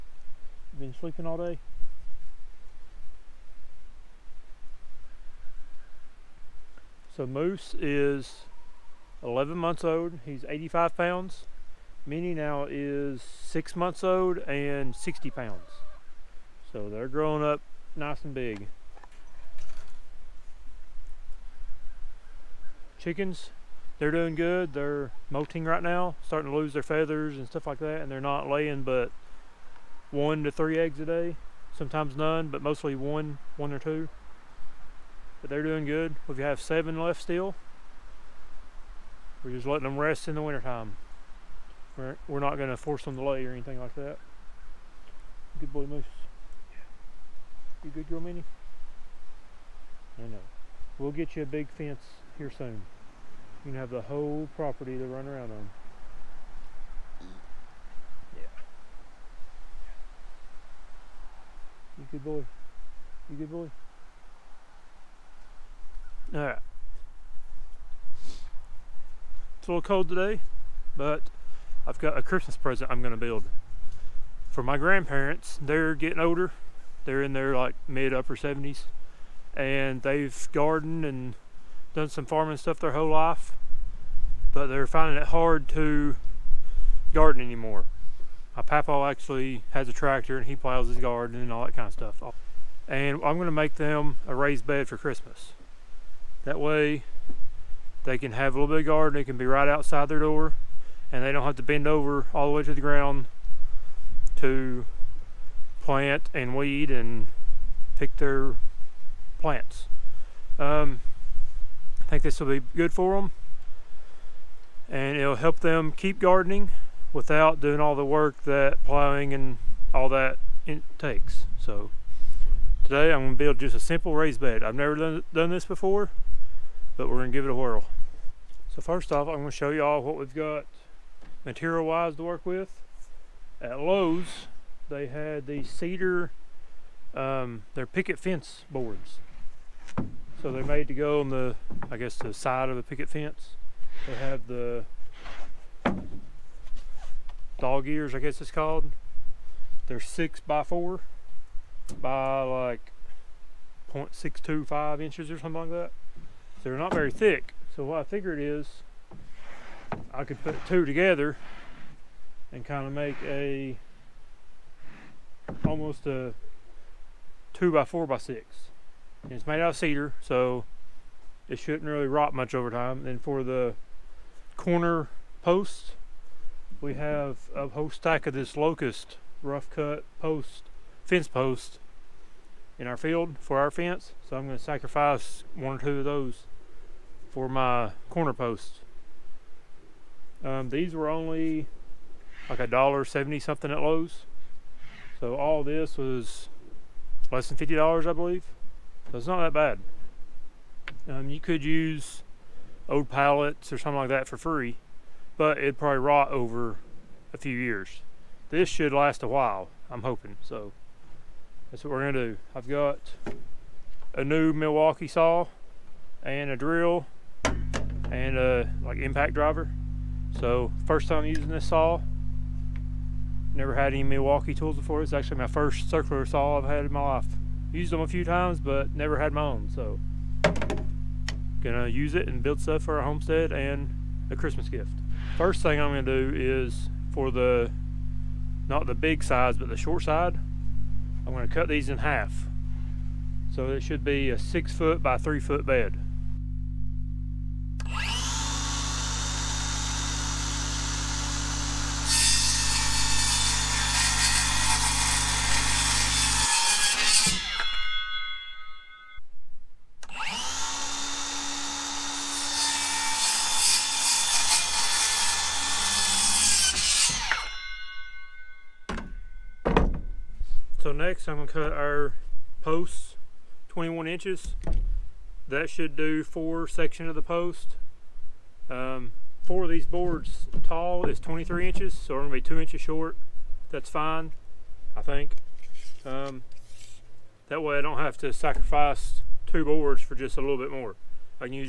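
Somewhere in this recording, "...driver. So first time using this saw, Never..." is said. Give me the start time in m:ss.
3:39.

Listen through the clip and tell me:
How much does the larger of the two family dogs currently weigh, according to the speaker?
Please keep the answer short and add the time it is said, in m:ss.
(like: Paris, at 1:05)
85 pounds, at 0:10.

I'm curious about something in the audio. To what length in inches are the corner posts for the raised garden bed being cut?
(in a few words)
21 inches.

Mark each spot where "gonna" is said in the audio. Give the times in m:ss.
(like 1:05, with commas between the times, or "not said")
1:33, 3:04, 3:32, 3:51, 3:55, 4:01, 4:31, 4:42.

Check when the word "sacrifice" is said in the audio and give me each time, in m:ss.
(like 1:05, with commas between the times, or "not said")
3:04, 4:48.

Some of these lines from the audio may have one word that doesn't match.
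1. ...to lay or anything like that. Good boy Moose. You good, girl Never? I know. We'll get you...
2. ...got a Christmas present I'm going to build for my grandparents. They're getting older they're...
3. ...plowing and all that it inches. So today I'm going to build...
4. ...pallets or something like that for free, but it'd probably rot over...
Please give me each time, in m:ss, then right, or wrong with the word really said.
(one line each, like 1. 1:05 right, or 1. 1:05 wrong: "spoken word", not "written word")
1. 0:43 wrong: "Minnie", not "Never"
2. 1:11 right
3. 1:58 wrong: "takes", not "inches"
4. 3:23 right.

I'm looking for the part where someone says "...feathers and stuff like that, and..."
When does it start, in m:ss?
0:26.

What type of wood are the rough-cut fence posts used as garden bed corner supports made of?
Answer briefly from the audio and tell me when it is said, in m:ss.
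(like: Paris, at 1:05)
Locust, at 2:58.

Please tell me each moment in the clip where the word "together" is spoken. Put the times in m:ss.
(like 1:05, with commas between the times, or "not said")
2:40.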